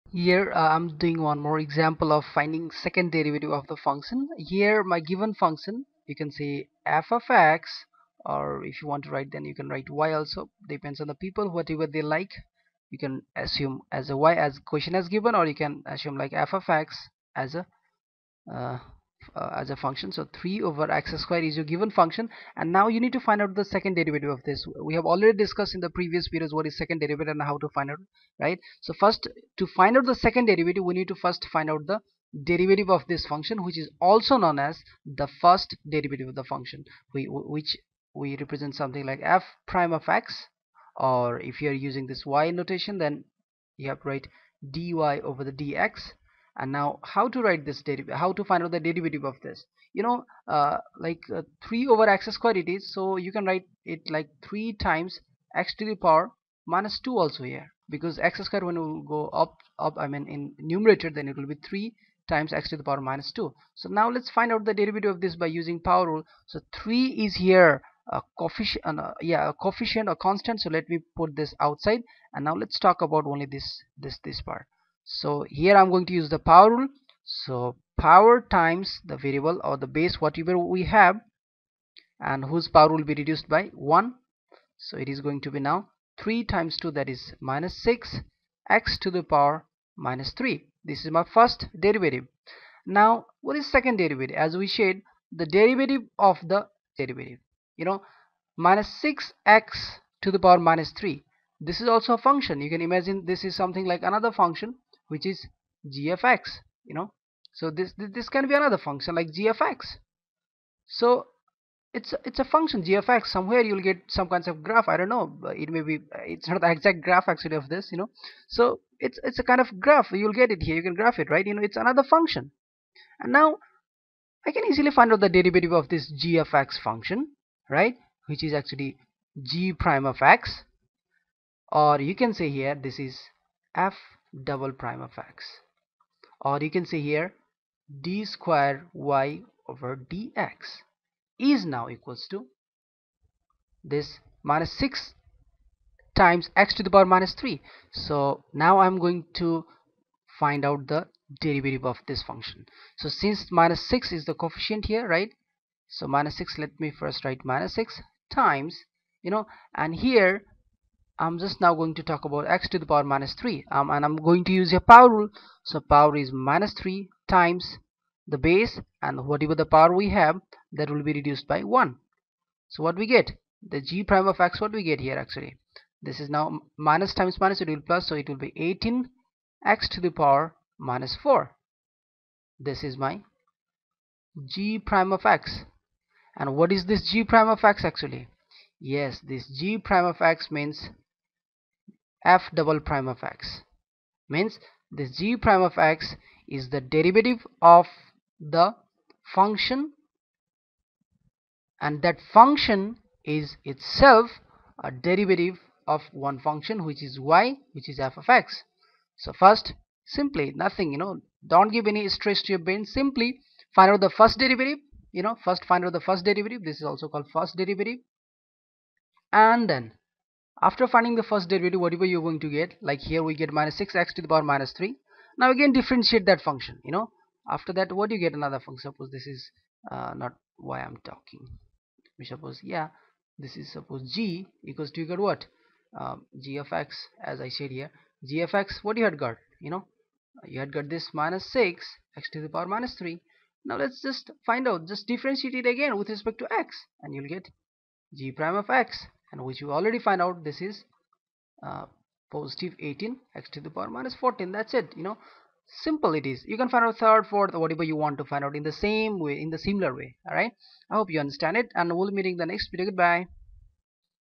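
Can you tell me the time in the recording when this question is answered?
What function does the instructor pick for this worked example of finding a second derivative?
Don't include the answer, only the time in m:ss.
0:20.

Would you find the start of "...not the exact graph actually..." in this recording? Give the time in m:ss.
1:56.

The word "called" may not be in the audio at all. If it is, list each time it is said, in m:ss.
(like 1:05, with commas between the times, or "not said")
3:37.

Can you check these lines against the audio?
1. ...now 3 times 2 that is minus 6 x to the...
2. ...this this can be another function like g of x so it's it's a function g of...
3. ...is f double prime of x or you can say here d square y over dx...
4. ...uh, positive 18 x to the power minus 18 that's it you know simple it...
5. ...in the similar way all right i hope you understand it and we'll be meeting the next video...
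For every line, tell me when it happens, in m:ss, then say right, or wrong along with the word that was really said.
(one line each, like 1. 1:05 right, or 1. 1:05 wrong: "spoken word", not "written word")
1. 1:25 right
2. 1:47 right
3. 2:12 right
4. 4:11 wrong: "14", not "18"
5. 4:19 right.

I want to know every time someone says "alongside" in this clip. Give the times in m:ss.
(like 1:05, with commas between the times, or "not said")
not said.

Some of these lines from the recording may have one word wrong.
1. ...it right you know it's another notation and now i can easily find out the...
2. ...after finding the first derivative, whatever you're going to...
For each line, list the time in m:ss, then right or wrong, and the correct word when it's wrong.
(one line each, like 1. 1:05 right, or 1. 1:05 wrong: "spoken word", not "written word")
1. 2:01 wrong: "function", not "notation"
2. 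3:40 right.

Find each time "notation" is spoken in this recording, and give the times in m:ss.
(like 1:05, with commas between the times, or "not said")
0:42.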